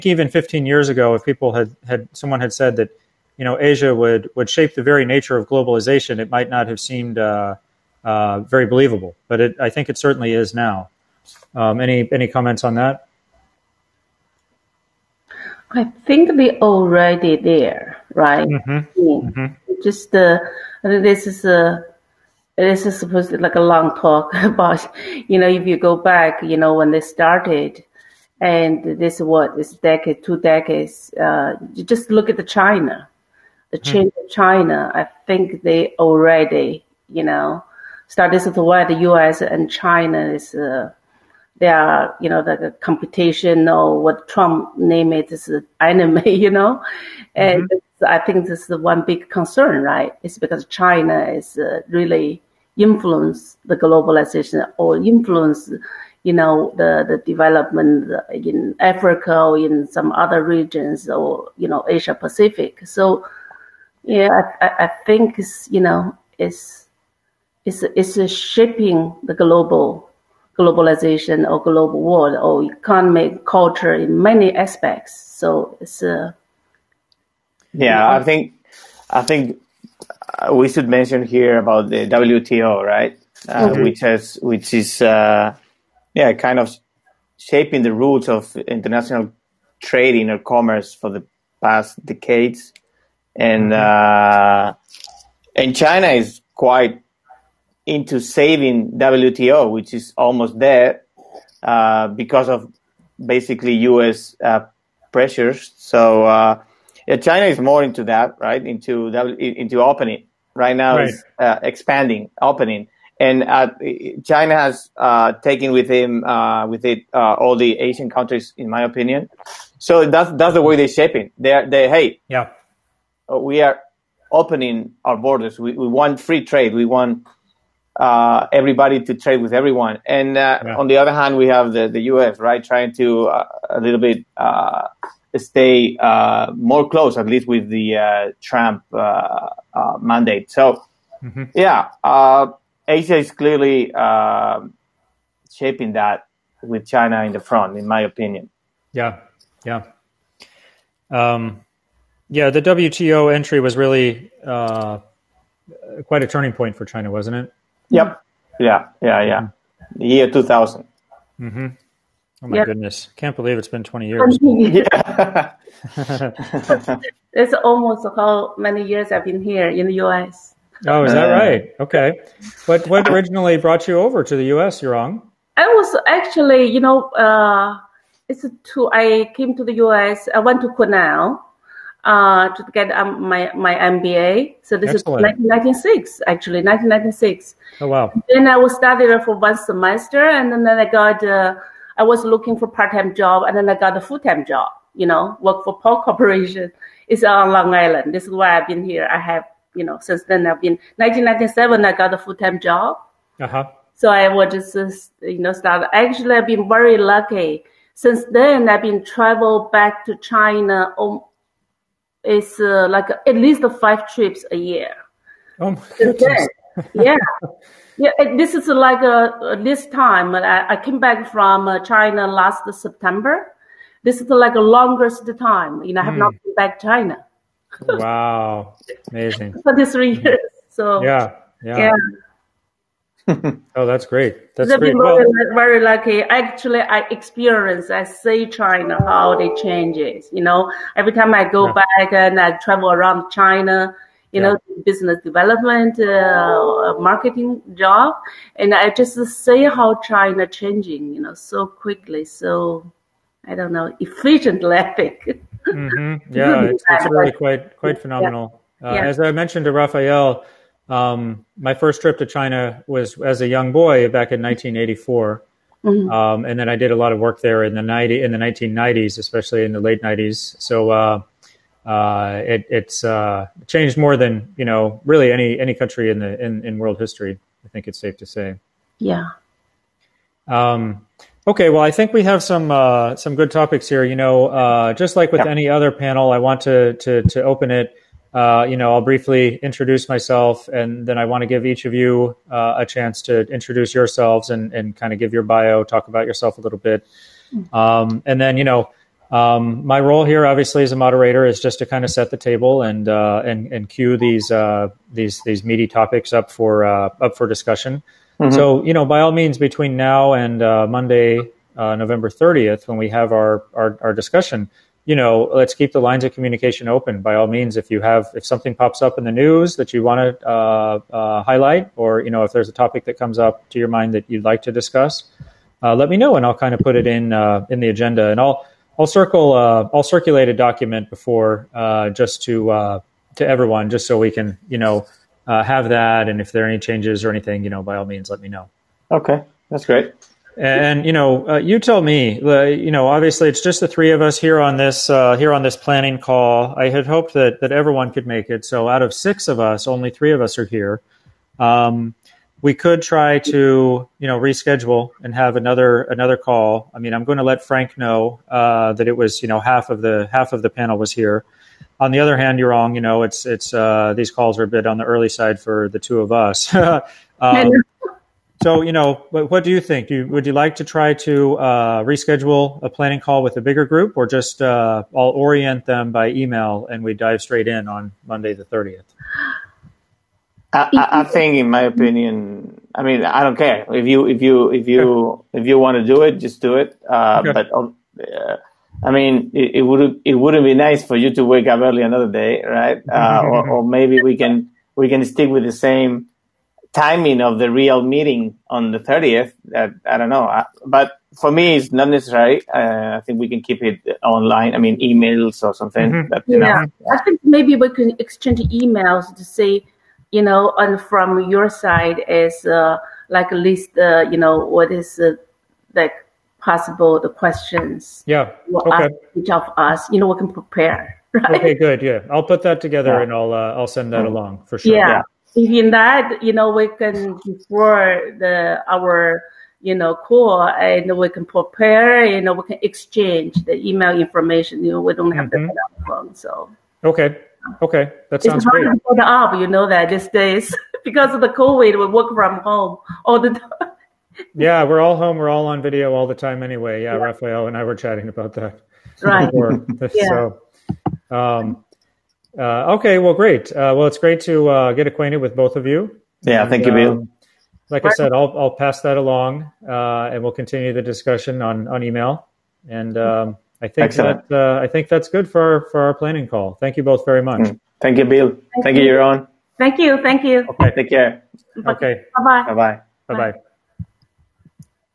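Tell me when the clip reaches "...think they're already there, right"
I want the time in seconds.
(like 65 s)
16 s.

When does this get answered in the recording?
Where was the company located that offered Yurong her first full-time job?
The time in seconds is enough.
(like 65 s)
197 s.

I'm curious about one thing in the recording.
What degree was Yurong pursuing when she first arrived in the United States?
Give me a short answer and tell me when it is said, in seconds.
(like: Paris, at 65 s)
MBA, at 183 s.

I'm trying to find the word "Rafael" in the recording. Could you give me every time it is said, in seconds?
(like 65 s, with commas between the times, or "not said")
259 s, 447 s.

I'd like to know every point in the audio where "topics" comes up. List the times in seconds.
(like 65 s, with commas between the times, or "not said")
283 s, 305 s, 322 s.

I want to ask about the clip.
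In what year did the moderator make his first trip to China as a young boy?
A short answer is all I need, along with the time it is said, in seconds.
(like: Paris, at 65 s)
1984, at 264 s.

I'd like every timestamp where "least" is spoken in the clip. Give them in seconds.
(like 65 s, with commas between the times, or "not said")
137 s, 213 s, 413 s.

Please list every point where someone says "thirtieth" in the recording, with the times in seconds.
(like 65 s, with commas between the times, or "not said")
312 s, 378 s.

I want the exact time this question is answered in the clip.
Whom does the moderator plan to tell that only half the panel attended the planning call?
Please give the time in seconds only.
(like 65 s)
357 s.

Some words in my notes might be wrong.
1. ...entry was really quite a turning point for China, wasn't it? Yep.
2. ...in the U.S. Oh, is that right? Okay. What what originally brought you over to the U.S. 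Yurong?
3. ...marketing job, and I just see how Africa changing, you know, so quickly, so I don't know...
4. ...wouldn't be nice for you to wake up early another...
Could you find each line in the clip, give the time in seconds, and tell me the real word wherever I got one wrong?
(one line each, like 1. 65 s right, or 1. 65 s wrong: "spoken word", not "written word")
1. 153 s right
2. 169 s right
3. 246 s wrong: "China", not "Africa"
4. 390 s right.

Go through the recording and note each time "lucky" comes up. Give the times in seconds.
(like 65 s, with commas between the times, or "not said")
206 s, 235 s.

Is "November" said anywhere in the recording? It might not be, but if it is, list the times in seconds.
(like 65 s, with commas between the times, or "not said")
311 s.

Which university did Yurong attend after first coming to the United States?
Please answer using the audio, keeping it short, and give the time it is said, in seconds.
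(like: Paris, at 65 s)
Cornell, at 180 s.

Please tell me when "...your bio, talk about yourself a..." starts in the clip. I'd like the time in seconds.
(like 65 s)
295 s.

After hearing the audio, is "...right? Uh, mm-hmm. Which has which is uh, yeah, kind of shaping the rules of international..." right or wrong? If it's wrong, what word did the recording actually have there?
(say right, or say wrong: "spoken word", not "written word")
right.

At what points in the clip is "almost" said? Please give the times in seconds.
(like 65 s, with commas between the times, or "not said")
100 s, 167 s.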